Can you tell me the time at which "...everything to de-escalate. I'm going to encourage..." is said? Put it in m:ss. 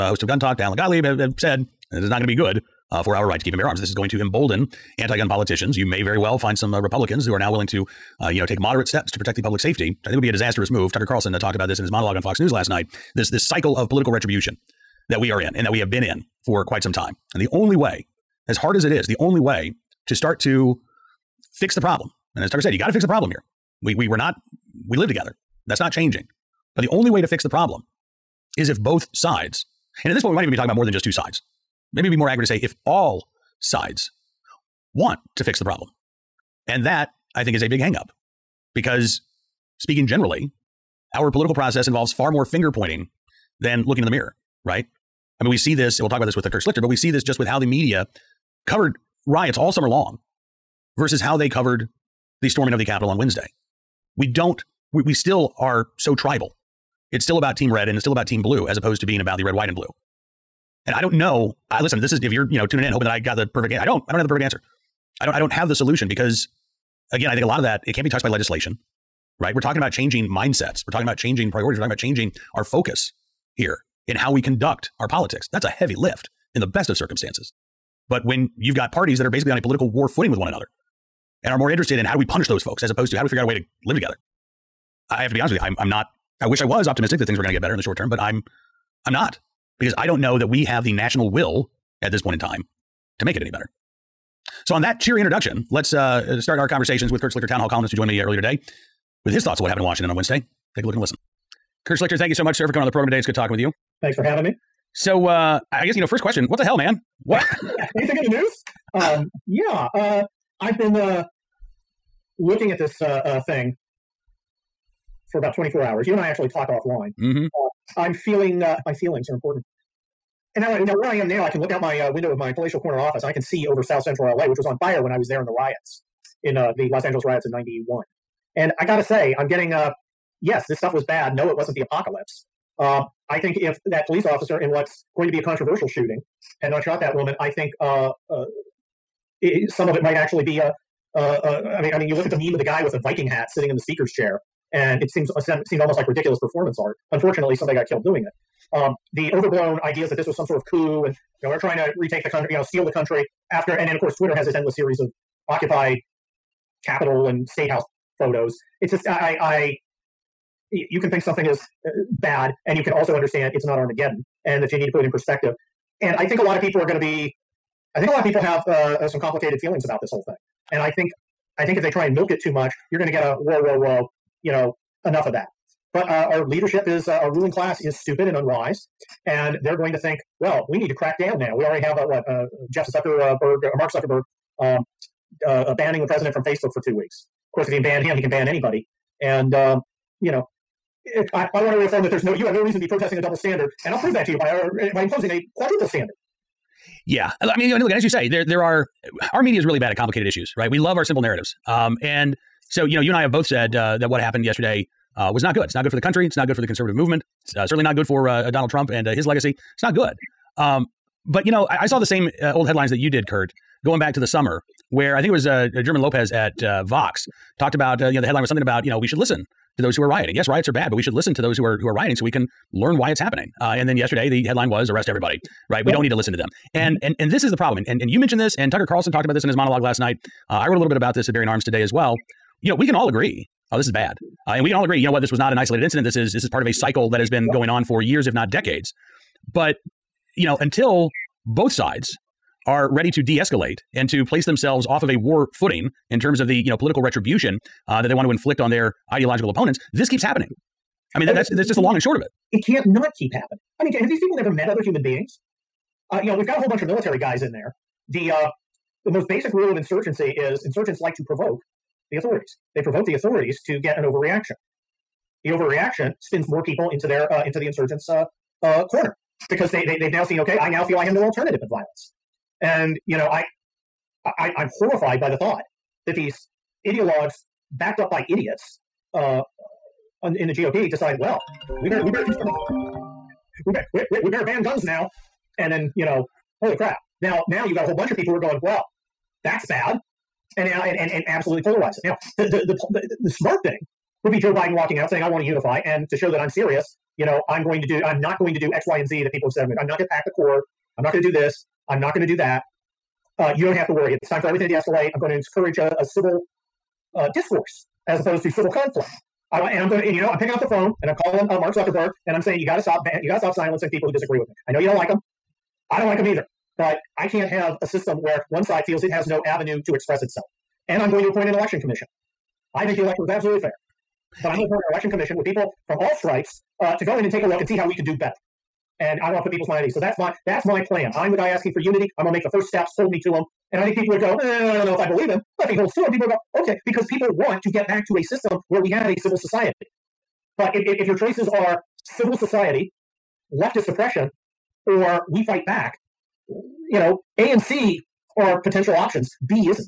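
5:04.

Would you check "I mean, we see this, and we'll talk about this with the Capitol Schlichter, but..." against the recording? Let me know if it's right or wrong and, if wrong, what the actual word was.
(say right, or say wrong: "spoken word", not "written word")
wrong: "Kurt", not "Capitol".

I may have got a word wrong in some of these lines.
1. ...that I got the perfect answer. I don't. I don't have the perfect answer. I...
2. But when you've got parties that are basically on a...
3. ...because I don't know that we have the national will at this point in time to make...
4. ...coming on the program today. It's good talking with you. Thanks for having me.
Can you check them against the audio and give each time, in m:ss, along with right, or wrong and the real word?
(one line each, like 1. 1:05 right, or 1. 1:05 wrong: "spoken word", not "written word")
1. 1:03 right
2. 1:18 right
3. 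1:29 right
4. 1:42 right.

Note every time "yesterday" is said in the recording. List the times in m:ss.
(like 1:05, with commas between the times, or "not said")
3:24, 3:43.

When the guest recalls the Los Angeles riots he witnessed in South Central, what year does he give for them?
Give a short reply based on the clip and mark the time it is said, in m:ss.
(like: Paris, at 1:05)
1991, at 2:07.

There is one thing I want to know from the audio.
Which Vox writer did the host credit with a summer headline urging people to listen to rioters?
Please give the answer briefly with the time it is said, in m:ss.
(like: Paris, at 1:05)
German Lopez, at 3:35.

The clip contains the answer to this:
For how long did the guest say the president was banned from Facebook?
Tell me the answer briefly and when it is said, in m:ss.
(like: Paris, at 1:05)
Two weeks, at 3:06.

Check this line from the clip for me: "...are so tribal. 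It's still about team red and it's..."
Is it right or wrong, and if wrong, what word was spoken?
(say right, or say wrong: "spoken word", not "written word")
right.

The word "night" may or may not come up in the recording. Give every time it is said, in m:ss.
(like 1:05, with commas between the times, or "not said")
0:12, 3:49.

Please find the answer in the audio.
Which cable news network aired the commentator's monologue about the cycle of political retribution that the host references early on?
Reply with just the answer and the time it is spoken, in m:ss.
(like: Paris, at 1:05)
Fox News, at 0:12.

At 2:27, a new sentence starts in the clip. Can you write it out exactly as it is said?
Unfortunately, somebody got killed doing it.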